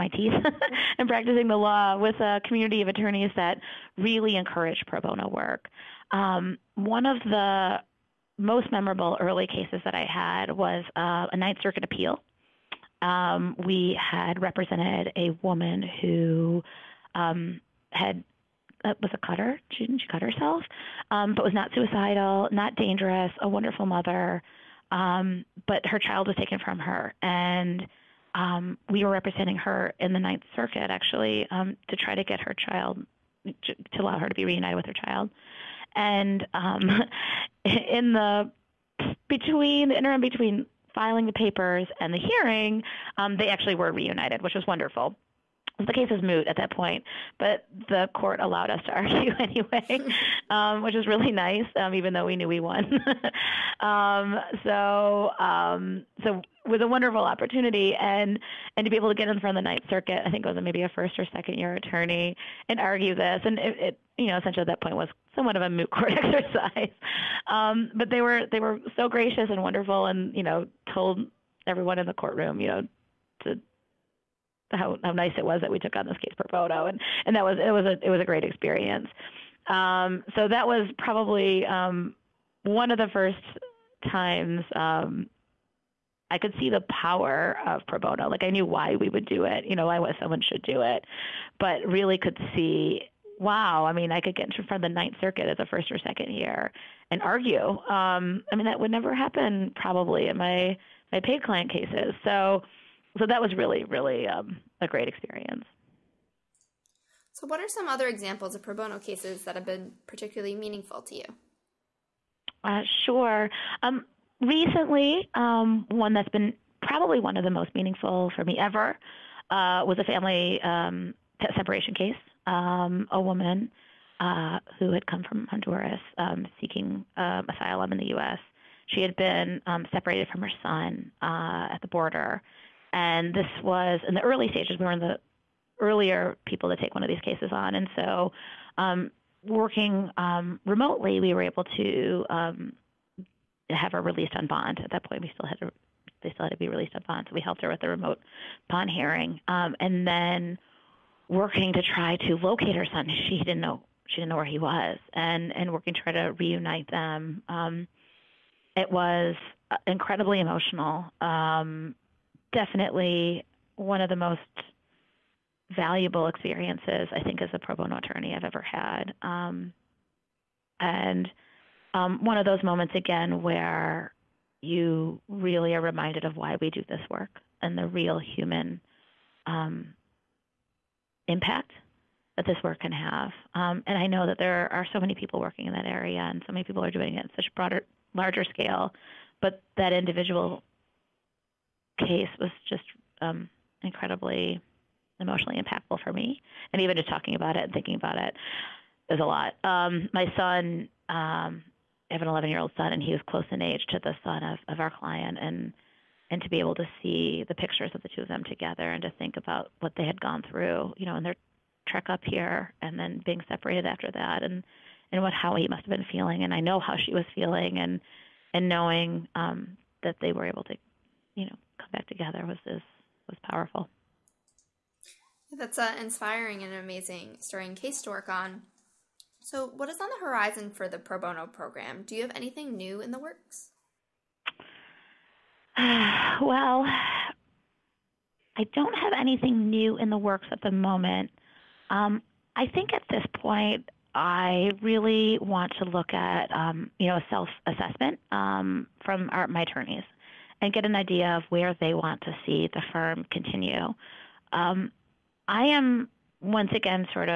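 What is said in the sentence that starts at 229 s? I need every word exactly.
So, what is on the horizon for the pro bono program?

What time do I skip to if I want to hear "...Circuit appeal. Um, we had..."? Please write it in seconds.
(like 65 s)
11 s.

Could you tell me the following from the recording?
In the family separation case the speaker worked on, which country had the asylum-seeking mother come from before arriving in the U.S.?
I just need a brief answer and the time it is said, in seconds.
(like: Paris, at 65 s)
Honduras, at 125 s.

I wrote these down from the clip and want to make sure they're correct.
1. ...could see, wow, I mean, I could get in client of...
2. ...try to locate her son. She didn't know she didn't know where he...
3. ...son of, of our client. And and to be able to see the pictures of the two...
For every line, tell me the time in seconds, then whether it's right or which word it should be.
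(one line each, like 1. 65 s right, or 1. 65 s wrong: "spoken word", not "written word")
1. 92 s wrong: "front", not "client"
2. 151 s right
3. 204 s right.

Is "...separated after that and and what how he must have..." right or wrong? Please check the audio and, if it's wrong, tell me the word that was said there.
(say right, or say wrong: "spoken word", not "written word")
right.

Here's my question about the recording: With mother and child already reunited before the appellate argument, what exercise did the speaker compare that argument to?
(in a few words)
Moot court.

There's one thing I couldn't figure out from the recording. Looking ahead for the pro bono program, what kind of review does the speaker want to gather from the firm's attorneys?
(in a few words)
Self assessment.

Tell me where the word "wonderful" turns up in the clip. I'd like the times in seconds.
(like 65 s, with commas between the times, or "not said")
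23 s, 44 s, 56 s, 69 s.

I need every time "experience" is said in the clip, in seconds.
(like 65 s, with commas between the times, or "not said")
78 s, 105 s, 166 s.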